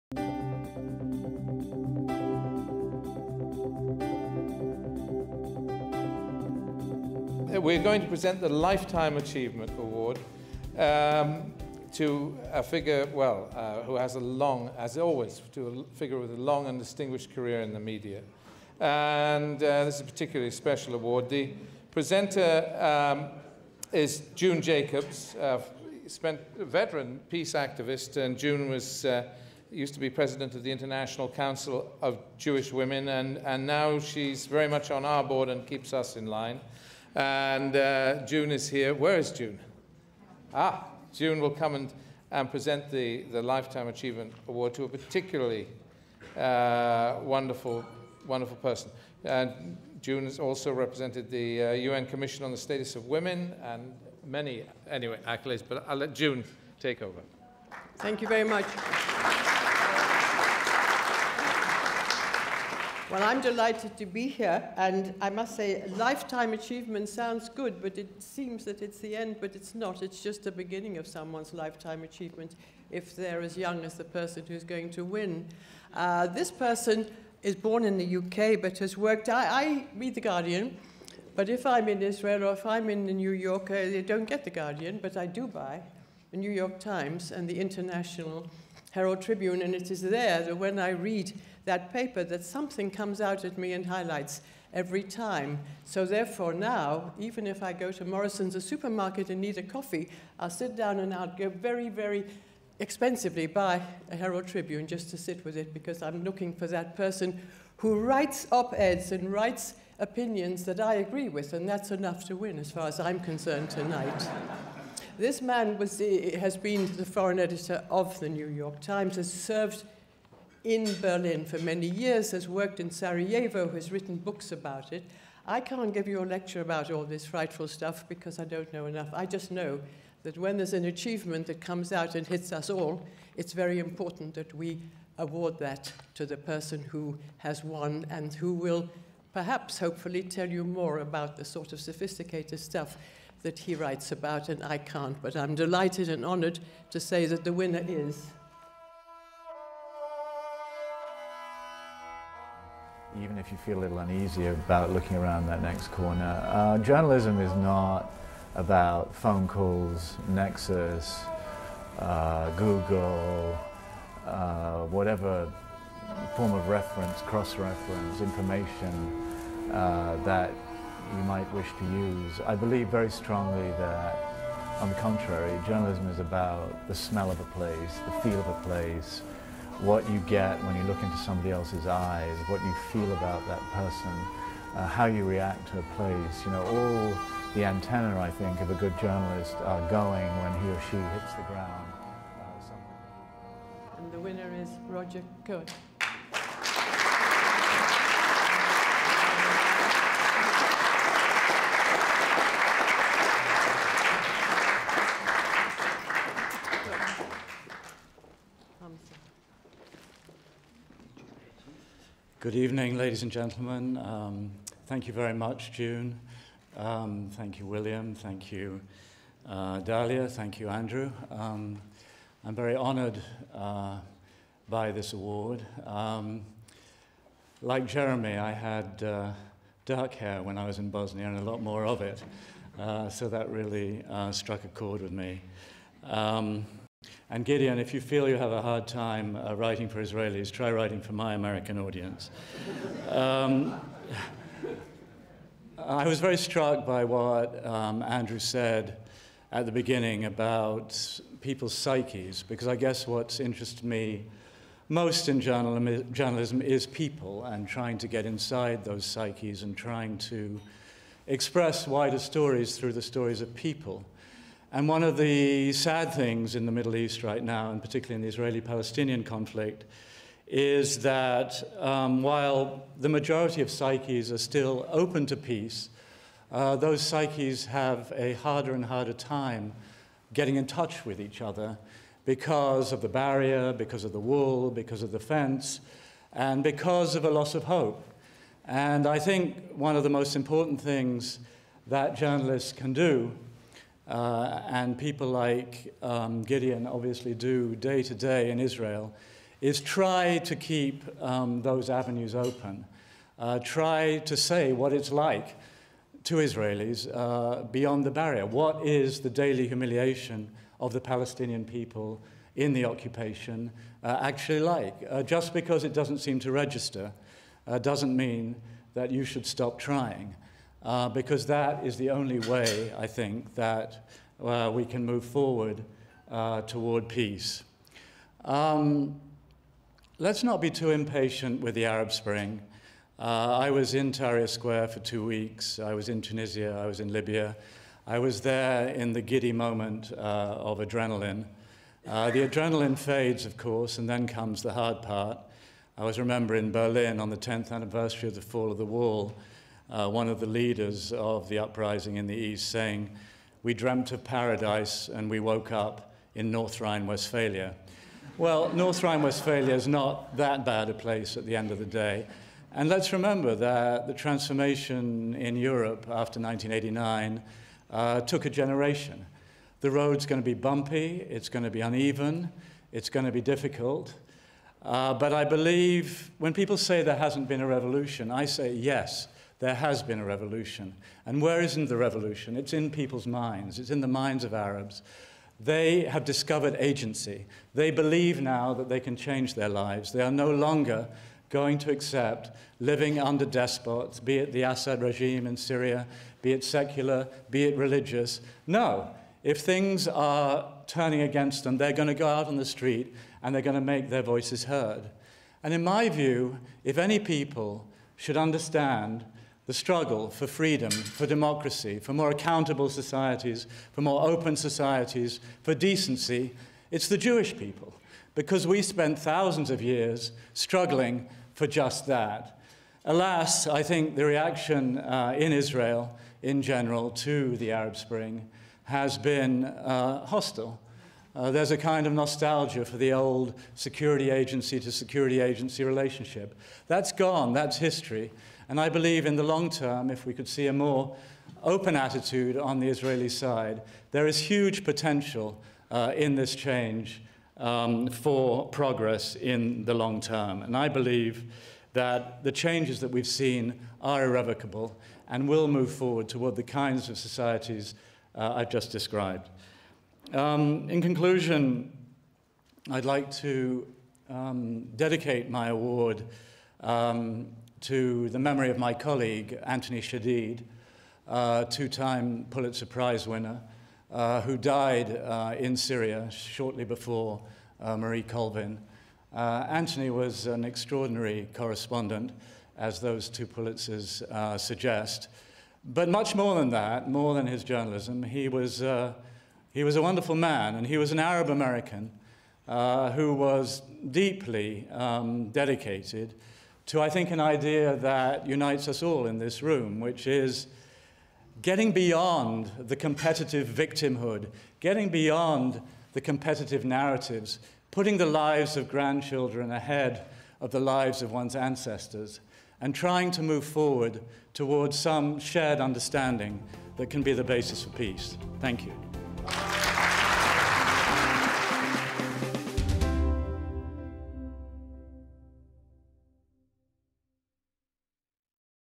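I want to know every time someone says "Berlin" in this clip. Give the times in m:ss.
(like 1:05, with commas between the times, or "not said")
2:01, 5:46.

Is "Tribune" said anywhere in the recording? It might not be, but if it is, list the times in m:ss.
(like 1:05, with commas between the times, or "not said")
1:29, 1:44.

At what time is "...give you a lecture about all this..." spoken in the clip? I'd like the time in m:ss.
2:05.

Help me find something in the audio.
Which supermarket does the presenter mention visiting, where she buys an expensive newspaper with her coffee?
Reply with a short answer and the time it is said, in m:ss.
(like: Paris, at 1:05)
Morrison's, at 1:38.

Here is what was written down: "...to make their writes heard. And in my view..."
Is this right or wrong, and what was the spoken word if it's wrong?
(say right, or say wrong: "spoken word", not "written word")
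wrong: "voices", not "writes".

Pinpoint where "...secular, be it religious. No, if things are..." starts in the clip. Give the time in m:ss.
6:36.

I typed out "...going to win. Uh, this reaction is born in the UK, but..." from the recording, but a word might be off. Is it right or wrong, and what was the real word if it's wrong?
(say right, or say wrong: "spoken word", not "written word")
wrong: "person", not "reaction".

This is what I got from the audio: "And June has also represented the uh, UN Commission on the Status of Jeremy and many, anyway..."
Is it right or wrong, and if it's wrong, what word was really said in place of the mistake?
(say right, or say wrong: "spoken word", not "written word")
wrong: "Women", not "Jeremy".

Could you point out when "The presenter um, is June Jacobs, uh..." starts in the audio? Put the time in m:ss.
0:21.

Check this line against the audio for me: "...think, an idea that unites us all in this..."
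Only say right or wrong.
right.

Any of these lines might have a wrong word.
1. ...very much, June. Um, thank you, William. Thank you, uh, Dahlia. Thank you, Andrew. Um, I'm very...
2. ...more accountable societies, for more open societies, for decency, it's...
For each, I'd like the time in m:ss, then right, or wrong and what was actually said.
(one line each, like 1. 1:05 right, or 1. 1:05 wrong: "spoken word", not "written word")
1. 3:35 right
2. 6:52 right.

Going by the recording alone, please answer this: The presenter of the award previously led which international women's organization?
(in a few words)
International Council of Jewish Women.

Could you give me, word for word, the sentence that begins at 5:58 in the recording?
Well, North Rhine Westphalia is not that bad a place at the end of the day.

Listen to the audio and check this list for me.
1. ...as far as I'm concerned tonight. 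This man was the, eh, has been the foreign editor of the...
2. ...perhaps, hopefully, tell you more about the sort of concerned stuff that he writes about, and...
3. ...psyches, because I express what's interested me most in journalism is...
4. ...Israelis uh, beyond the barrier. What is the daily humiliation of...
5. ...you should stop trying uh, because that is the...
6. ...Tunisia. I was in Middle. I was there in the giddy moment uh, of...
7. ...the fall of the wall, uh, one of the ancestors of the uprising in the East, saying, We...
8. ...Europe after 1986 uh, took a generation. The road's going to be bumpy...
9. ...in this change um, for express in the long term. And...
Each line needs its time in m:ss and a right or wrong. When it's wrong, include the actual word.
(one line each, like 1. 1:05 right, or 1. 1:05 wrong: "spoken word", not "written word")
1. 1:52 right
2. 2:19 wrong: "sophisticated", not "concerned"
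3. 4:11 wrong: "guess", not "express"
4. 5:06 right
5. 5:19 right
6. 5:36 wrong: "Libya", not "Middle"
7. 5:48 wrong: "leaders", not "ancestors"
8. 6:05 wrong: "1989", not "1986"
9. 7:26 wrong: "progress", not "express".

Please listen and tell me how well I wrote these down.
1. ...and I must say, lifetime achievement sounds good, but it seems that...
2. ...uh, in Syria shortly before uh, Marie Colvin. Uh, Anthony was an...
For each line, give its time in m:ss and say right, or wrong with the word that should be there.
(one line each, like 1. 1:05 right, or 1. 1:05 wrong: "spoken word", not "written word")
1. 1:04 right
2. 7:55 right.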